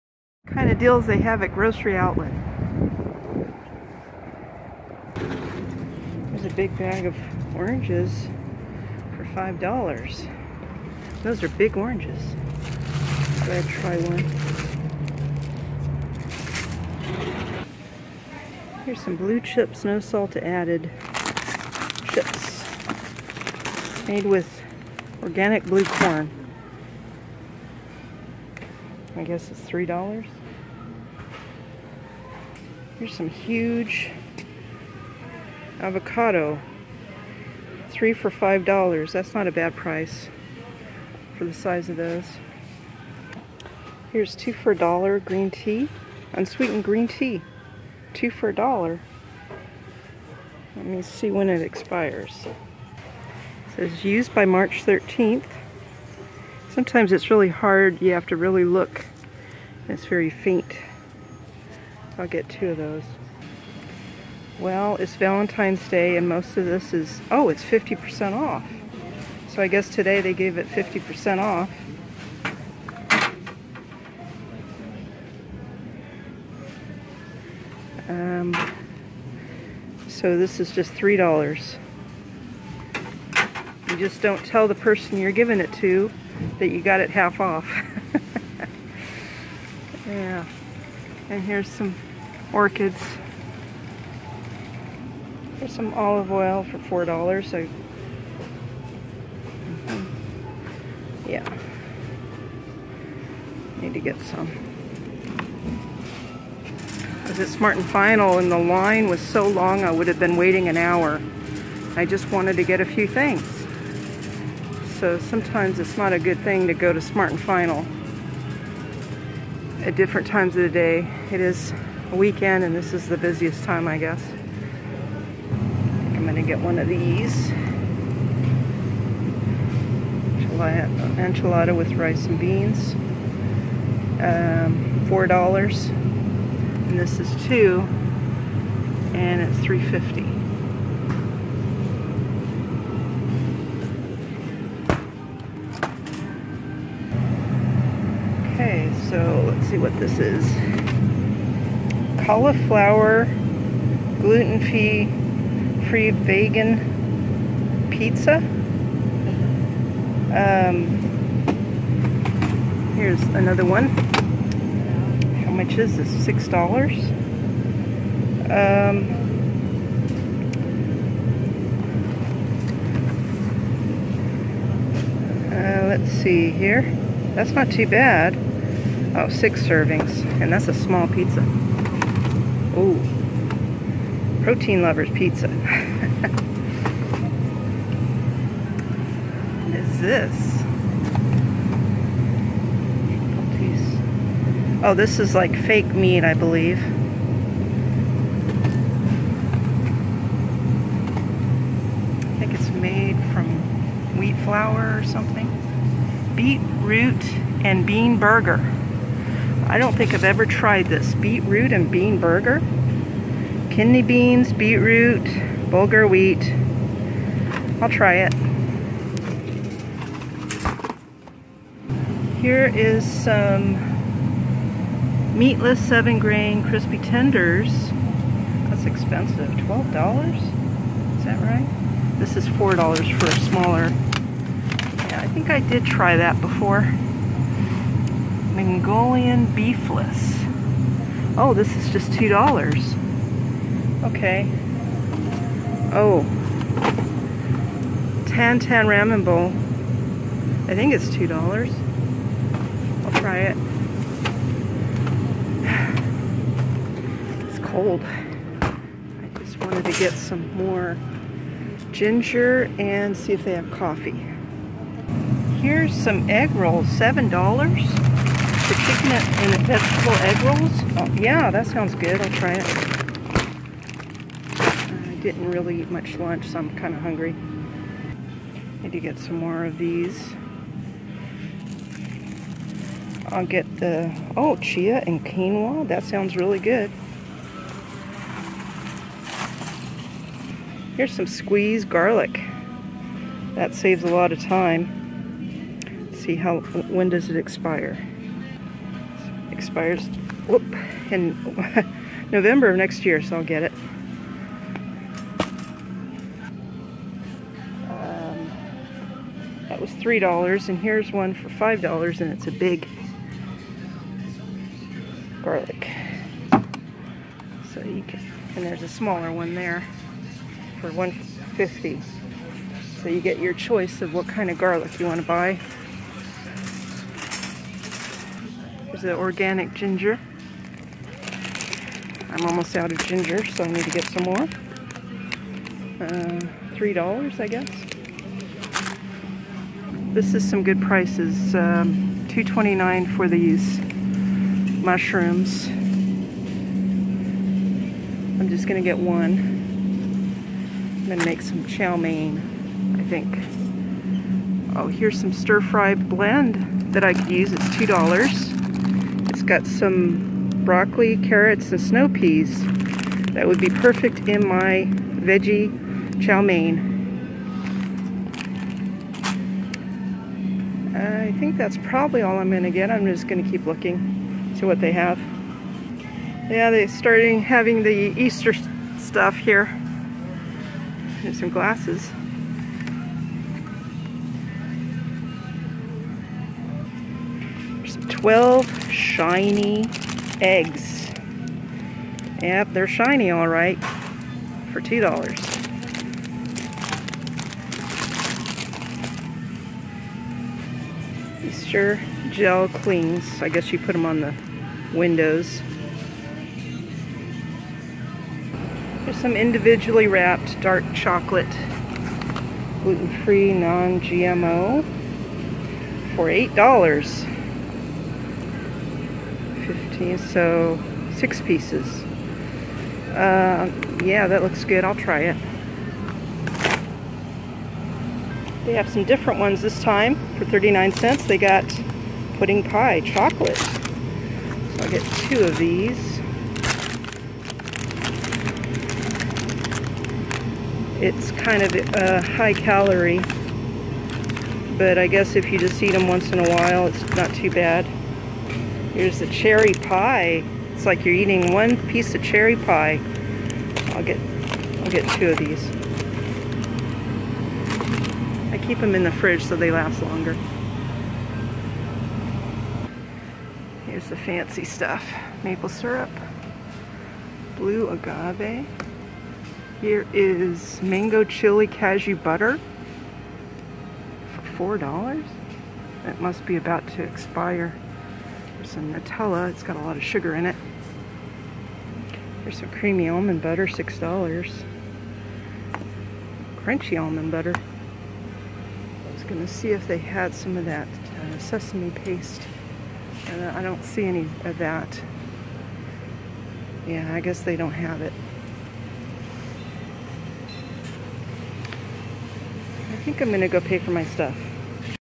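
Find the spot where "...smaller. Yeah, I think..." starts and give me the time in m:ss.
3:53.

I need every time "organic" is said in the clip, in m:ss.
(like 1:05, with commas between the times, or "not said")
0:25, 5:29.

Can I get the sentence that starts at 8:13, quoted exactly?
And I don't see any of that.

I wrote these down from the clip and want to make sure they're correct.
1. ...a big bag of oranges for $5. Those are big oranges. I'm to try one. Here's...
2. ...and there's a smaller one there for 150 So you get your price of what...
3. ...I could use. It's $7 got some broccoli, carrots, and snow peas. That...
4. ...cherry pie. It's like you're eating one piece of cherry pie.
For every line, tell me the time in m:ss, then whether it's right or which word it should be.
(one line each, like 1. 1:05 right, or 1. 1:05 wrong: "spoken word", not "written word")
1. 0:06 right
2. 5:18 wrong: "choice", not "price"
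3. 5:57 wrong: "2", not "7"
4. 7:29 right.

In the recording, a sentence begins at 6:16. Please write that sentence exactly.
Yeah, they're starting having the Easter stuff here.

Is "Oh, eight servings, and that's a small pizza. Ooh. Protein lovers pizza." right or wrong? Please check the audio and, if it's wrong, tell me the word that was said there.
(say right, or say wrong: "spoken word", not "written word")
wrong: "six", not "eight".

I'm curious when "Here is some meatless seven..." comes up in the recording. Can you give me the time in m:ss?
3:42.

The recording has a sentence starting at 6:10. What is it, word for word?
I think that's probably all I'm going to get.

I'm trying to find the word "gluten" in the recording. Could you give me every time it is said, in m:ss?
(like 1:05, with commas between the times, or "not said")
2:34, 6:52.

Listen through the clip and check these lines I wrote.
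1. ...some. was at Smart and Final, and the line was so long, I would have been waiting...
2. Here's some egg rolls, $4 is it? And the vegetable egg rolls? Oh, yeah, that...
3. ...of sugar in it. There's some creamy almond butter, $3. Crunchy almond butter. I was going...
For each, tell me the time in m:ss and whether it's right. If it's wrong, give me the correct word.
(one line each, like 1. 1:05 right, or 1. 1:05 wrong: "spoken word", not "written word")
1. 1:44 right
2. 4:25 wrong: "7", not "4"
3. 7:59 wrong: "6", not "3".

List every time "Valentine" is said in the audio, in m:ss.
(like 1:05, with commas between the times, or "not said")
1:05.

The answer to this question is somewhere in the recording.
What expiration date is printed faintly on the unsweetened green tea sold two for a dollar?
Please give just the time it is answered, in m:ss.
0:54.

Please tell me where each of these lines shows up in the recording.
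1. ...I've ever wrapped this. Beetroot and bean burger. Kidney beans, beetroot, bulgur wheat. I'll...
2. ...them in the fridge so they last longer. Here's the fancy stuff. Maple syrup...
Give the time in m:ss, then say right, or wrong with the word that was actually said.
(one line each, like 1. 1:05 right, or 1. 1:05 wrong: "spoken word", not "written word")
1. 3:30 wrong: "tried", not "wrapped"
2. 7:38 right.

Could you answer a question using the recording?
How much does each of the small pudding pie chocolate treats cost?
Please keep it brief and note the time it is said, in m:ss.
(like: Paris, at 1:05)
39 cents, at 7:10.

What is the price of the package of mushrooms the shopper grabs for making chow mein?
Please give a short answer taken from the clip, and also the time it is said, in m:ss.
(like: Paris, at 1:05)
$2.29, at 5:42.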